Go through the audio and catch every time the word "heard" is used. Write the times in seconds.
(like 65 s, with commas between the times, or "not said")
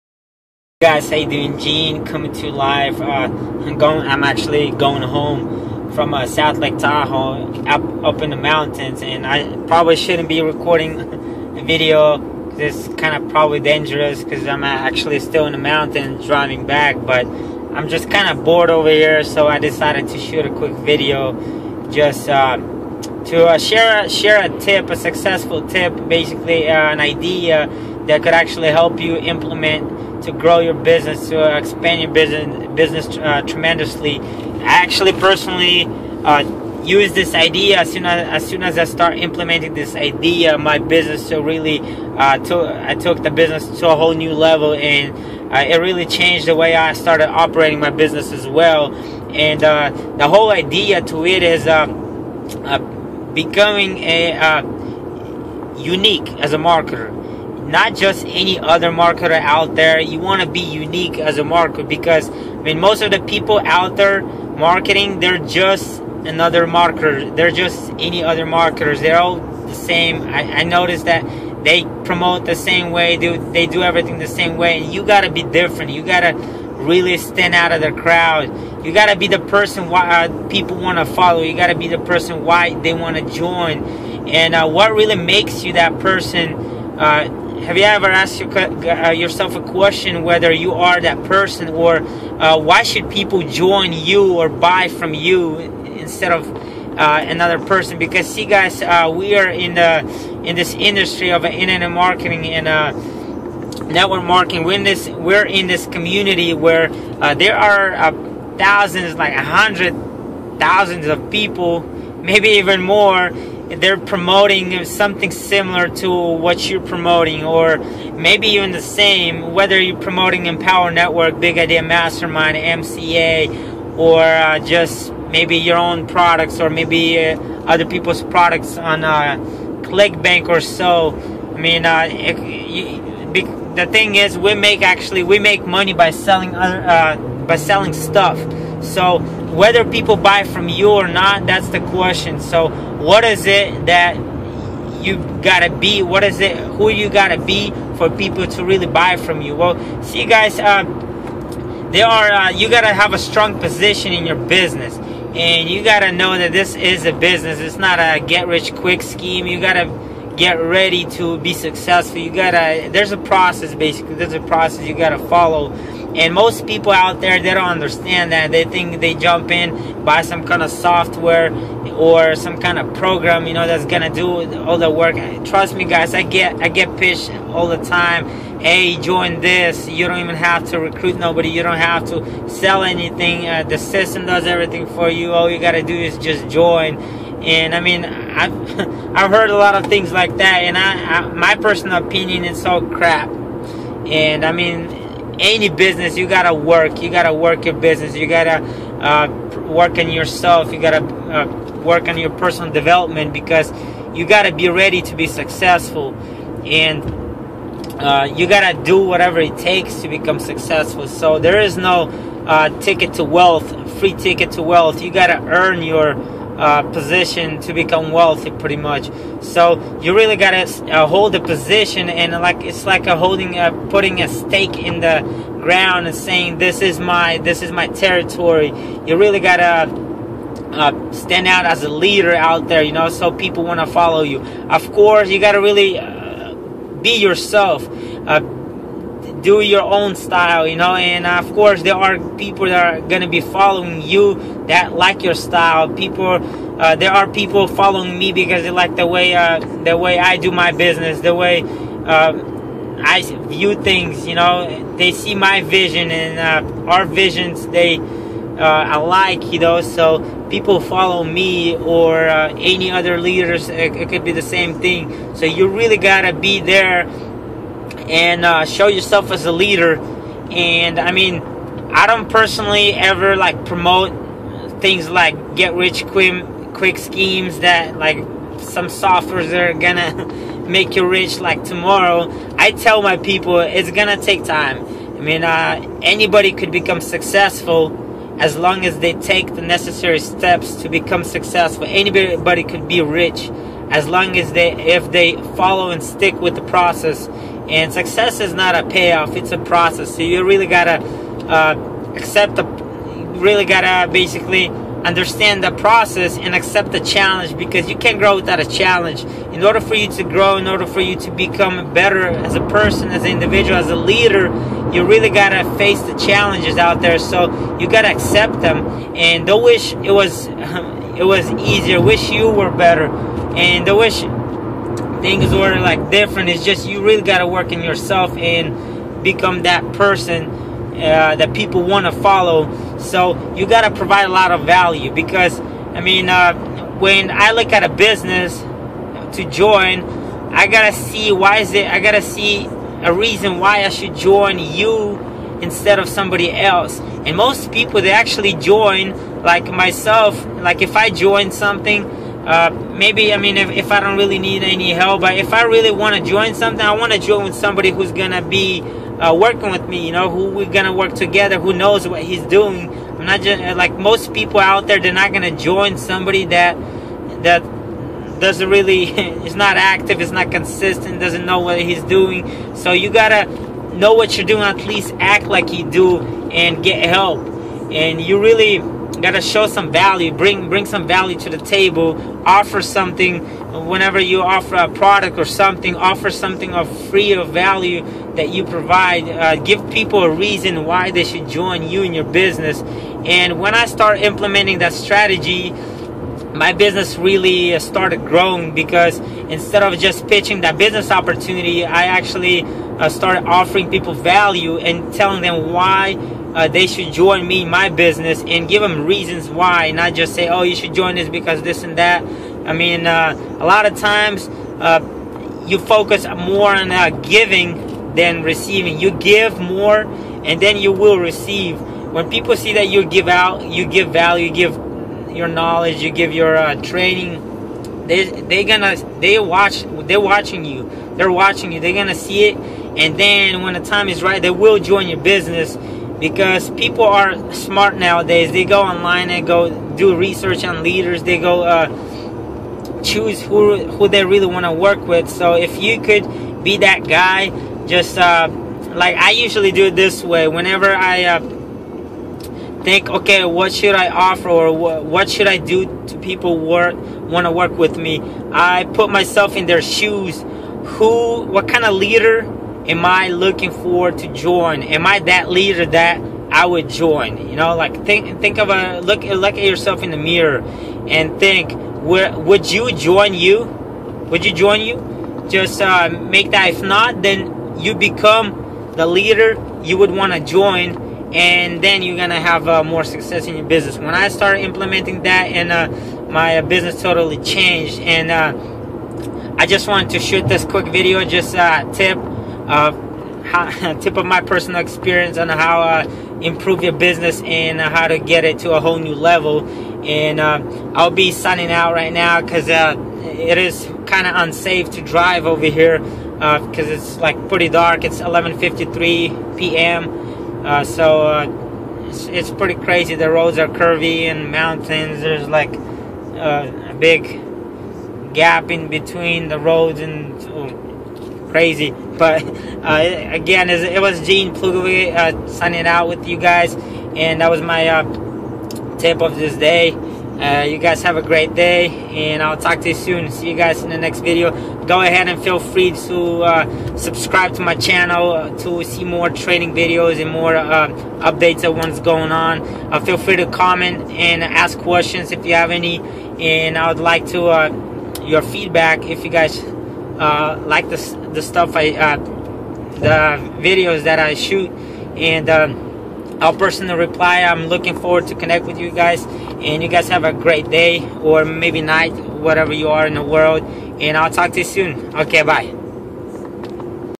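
189 s.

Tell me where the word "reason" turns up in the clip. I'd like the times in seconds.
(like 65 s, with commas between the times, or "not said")
343 s, 390 s, 409 s.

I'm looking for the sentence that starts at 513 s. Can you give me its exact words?
The roads are curvy and mountains.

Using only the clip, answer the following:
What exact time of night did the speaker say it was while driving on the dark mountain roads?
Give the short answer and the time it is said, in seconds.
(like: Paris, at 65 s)
11:53 p.m., at 508 s.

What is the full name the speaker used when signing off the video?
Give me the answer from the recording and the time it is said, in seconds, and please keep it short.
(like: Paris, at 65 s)
Gene Plugovoy, at 524 s.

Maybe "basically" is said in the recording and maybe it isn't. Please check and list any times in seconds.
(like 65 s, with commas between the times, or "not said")
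26 s, 163 s, 304 s.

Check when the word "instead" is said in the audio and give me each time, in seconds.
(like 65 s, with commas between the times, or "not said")
95 s, 345 s, 399 s.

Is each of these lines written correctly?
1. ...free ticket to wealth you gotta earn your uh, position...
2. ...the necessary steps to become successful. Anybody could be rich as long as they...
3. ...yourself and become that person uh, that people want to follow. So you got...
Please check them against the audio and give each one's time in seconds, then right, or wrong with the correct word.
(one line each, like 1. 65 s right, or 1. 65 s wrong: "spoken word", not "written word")
1. 213 s right
2. 289 s right
3. 327 s right.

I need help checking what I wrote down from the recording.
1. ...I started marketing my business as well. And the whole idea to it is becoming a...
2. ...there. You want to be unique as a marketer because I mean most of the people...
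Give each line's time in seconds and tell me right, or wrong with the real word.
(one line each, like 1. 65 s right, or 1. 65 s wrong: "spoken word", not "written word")
1. 46 s wrong: "operating", not "marketing"
2. 59 s right.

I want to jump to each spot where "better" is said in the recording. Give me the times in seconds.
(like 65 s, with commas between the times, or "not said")
311 s, 322 s.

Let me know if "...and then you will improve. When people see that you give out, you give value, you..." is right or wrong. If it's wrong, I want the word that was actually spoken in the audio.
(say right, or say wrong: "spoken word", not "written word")
wrong: "receive", not "improve".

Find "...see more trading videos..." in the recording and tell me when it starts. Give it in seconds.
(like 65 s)
538 s.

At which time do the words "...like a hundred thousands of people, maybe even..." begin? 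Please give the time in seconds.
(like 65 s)
109 s.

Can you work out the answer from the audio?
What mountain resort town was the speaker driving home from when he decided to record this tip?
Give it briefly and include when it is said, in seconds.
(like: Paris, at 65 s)
South Lake Tahoe, at 6 s.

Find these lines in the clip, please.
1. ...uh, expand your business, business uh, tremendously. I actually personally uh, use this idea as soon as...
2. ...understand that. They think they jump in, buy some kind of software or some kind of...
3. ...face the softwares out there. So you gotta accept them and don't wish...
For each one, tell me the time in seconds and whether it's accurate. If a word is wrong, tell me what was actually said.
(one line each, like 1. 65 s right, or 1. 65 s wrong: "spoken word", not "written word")
1. 31 s right
2. 167 s right
3. 315 s wrong: "challenges", not "softwares".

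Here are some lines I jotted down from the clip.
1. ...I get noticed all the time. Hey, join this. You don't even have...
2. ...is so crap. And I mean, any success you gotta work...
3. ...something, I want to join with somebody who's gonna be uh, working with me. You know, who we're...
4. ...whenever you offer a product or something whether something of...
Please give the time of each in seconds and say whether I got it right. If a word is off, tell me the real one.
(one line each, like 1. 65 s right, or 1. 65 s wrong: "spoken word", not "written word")
1. 176 s wrong: "pitched", not "noticed"
2. 192 s wrong: "business", not "success"
3. 356 s right
4. 383 s wrong: "offer", not "whether".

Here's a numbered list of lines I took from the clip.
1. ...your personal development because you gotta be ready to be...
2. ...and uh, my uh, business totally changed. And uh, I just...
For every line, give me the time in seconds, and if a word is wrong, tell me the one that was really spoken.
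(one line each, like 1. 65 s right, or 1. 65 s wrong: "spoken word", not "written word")
1. 202 s right
2. 485 s right.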